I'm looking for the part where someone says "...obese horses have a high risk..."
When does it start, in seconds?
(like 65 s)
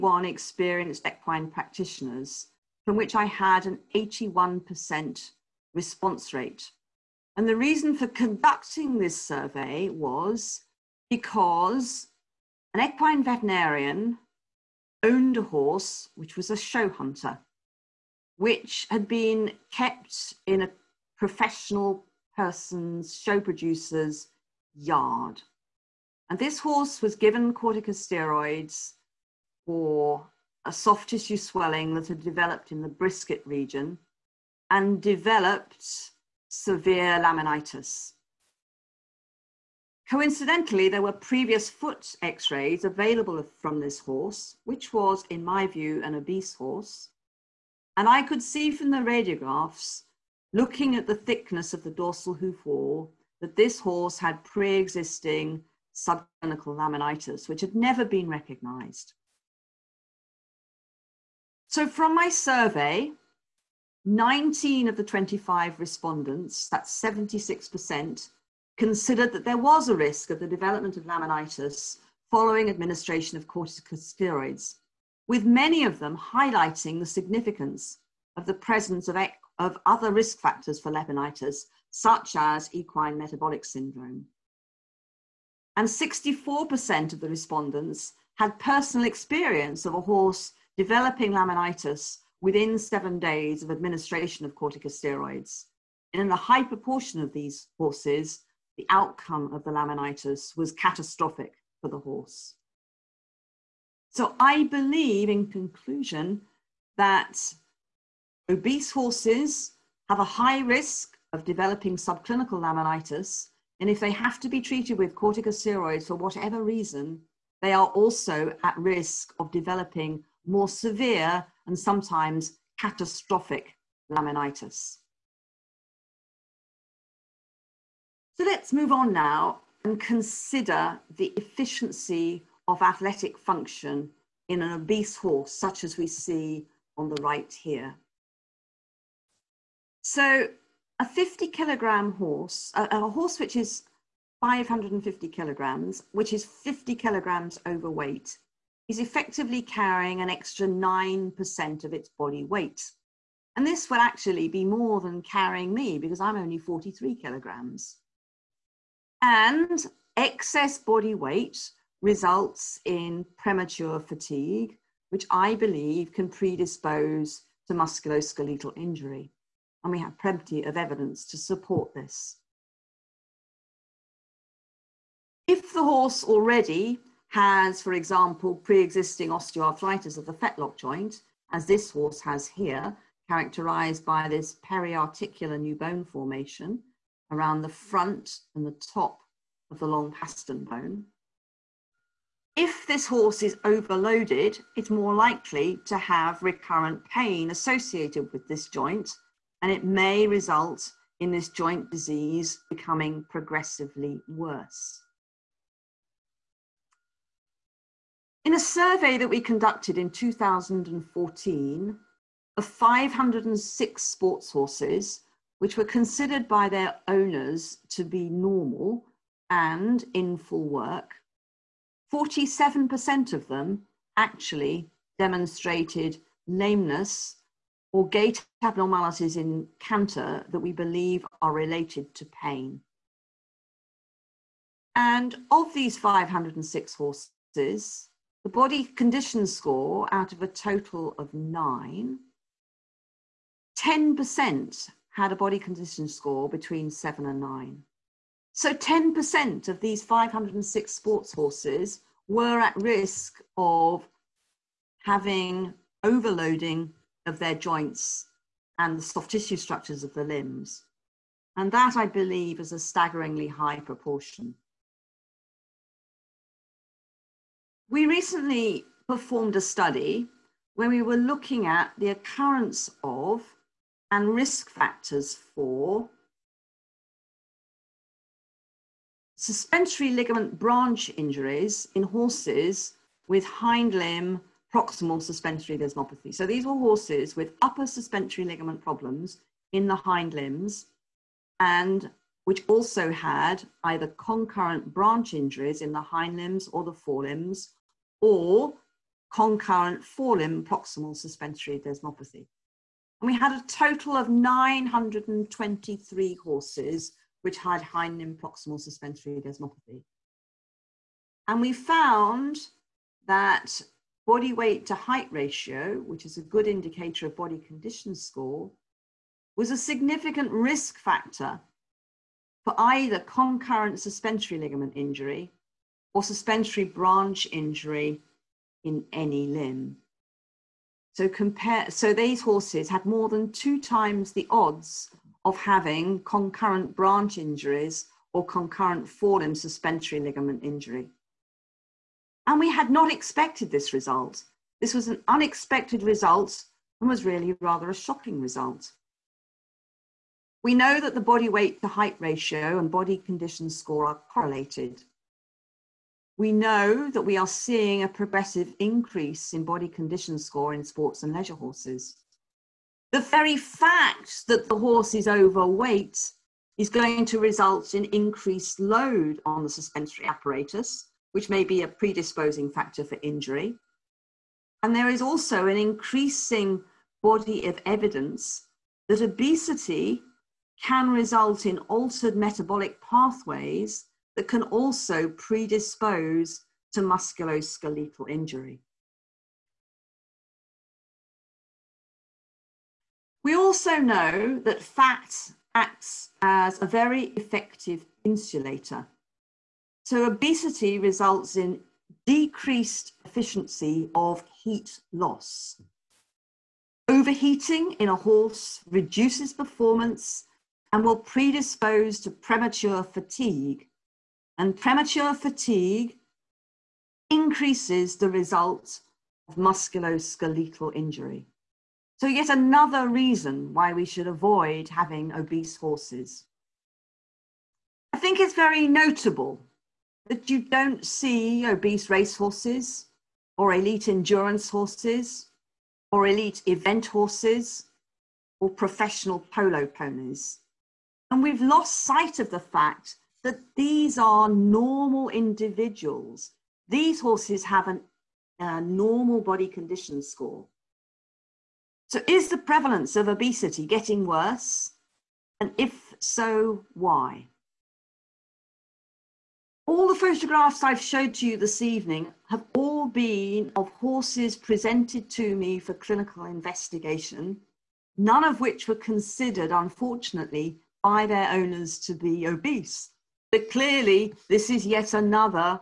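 108 s.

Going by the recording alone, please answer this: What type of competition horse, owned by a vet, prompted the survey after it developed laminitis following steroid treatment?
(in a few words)
show hunter.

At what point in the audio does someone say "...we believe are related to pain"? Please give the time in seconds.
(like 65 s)
230 s.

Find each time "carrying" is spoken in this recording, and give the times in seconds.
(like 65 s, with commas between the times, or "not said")
149 s, 155 s.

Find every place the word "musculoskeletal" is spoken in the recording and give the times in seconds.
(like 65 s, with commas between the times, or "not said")
167 s, 387 s, 419 s.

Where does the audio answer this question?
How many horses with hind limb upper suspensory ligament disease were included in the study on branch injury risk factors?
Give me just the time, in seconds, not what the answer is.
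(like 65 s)
304 s.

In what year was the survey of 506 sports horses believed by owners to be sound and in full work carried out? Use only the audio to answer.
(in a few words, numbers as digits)
2014.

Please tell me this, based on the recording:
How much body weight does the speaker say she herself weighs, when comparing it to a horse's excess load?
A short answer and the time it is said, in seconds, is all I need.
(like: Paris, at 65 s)
43 kilograms, at 156 s.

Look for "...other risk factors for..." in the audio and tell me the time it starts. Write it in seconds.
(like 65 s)
79 s.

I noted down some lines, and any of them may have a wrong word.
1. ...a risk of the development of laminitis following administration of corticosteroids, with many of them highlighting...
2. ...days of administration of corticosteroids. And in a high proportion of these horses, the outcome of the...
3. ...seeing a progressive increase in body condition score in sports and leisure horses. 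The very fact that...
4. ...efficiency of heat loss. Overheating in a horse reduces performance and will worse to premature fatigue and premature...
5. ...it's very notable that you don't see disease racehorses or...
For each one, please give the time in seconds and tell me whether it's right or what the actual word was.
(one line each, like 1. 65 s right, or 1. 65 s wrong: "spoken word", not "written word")
1. 69 s right
2. 93 s right
3. 357 s right
4. 403 s wrong: "predispose", not "worse"
5. 428 s wrong: "obese", not "disease".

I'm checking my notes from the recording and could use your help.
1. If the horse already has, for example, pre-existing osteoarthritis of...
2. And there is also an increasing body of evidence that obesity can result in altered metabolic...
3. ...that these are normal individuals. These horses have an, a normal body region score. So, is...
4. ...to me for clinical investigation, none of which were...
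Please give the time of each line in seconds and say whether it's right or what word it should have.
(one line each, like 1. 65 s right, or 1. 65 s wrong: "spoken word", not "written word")
1. 175 s right
2. 374 s right
3. 443 s wrong: "condition", not "region"
4. 465 s right.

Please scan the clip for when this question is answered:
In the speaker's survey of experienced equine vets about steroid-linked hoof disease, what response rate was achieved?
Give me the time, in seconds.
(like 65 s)
3 s.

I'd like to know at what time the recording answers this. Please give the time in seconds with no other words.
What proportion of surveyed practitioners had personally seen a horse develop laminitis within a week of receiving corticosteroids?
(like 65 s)
85 s.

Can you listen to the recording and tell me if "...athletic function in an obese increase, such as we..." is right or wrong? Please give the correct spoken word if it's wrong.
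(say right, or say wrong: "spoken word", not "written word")
wrong: "horse", not "increase".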